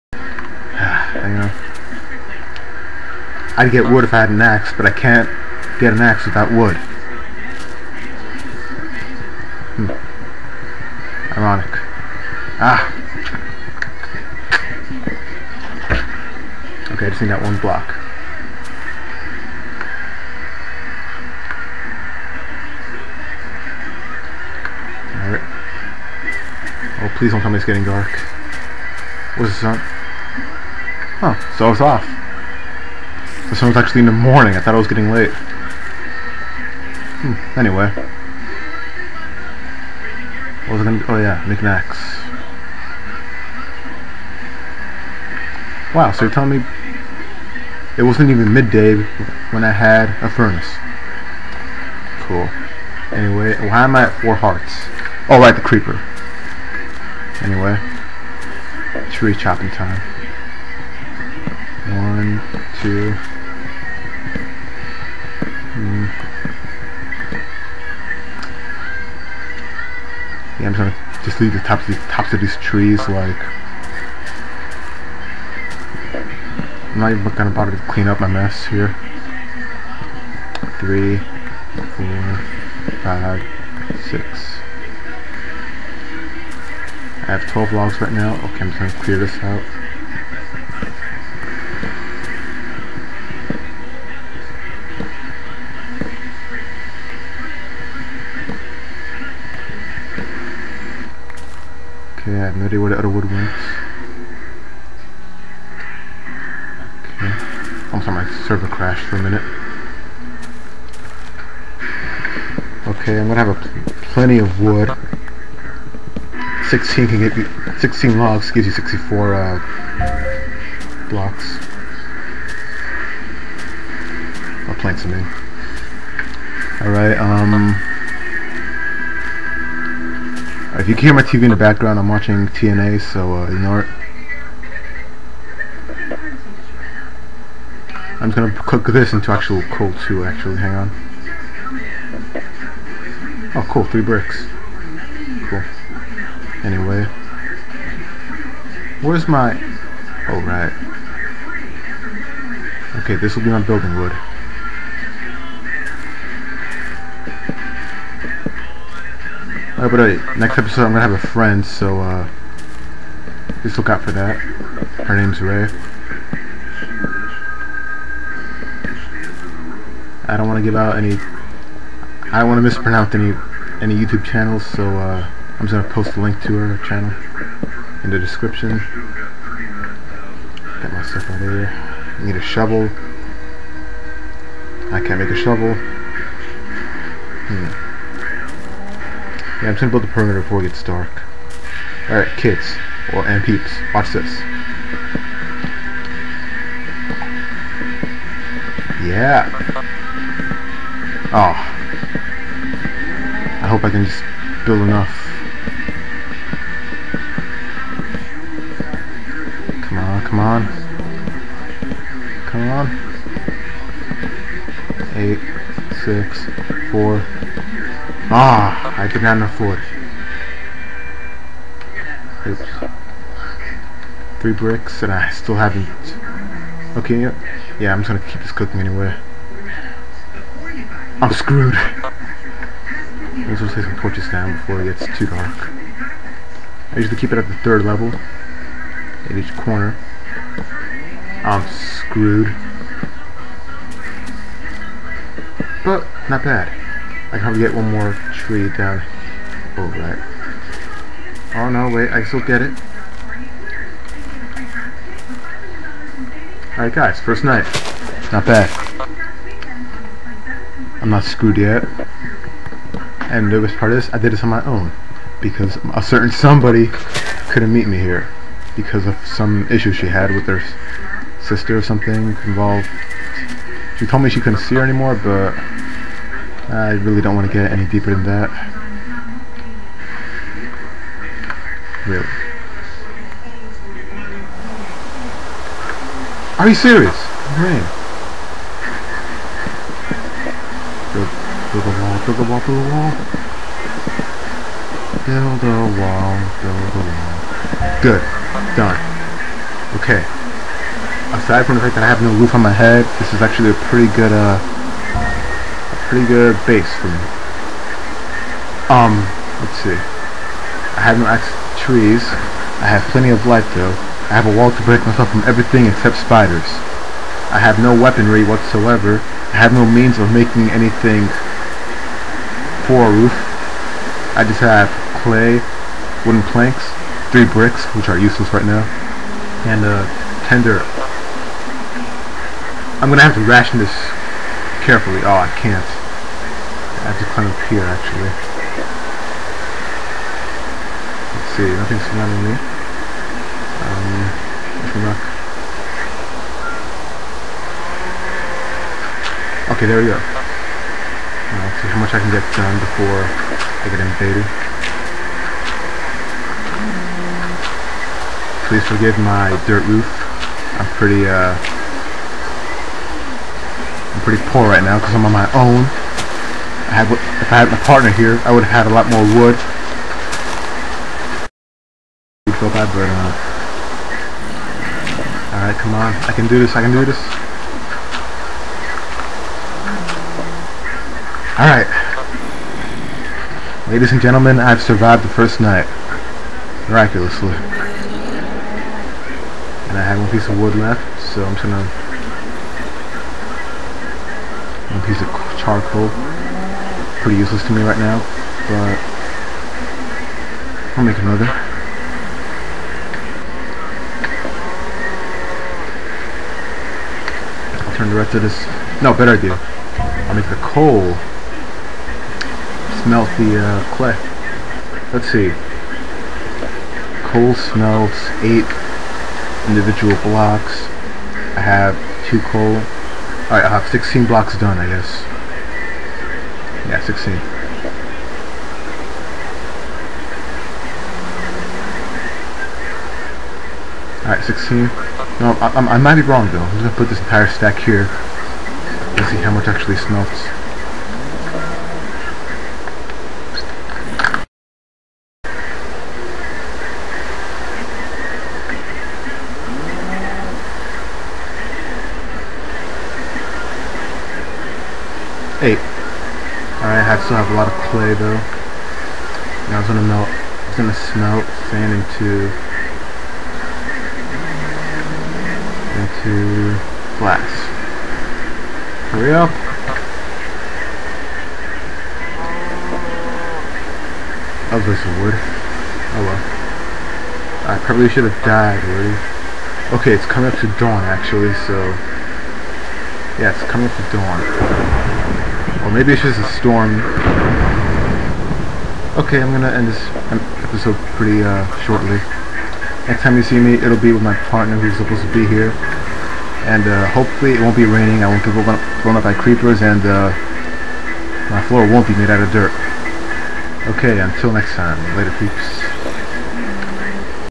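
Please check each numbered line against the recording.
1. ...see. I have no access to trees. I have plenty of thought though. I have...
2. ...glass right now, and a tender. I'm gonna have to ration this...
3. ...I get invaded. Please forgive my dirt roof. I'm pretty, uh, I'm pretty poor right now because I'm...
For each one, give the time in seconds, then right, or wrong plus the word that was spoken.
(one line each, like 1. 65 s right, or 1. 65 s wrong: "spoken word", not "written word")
1. 309 s wrong: "light", not "thought"
2. 328 s wrong: "useless", not "glass"
3. 353 s right.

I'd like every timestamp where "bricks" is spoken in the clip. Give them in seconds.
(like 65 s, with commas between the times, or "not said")
144 s, 224 s, 327 s.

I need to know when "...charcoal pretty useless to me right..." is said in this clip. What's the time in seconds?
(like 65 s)
395 s.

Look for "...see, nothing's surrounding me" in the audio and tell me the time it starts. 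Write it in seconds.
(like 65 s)
341 s.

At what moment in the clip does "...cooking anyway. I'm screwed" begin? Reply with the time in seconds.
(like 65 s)
228 s.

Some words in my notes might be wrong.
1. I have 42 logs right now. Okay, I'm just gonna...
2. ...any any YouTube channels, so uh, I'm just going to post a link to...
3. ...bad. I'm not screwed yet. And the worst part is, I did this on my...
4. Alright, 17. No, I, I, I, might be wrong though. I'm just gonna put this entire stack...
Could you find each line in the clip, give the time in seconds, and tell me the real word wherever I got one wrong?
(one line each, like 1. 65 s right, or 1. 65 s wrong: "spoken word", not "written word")
1. 87 s wrong: "12", not "42"
2. 173 s right
3. 258 s right
4. 434 s wrong: "16", not "17".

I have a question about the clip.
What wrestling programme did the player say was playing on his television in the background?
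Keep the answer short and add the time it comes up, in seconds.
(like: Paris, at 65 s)
TNA, at 132 s.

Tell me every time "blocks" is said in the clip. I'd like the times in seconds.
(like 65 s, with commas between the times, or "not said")
17 s, 121 s, 420 s, 424 s.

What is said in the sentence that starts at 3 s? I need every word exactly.
I'd get wood if I had an axe, but I can't get an axe without wood.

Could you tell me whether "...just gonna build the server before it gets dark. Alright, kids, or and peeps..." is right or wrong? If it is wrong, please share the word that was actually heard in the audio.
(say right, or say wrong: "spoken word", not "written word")
wrong: "perimeter", not "server".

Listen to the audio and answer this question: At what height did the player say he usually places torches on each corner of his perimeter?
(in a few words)
third level.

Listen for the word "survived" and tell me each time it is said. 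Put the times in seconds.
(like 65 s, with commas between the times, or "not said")
384 s.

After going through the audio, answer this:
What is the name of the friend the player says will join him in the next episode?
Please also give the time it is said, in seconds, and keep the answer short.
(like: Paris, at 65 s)
Rei, at 165 s.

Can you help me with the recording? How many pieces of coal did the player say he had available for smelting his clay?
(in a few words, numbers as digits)
2.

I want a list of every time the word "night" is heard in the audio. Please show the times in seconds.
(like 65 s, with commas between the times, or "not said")
257 s, 385 s.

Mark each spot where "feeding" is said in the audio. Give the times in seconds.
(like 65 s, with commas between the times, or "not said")
not said.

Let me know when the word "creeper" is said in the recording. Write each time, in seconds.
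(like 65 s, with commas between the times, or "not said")
55 s, 499 s.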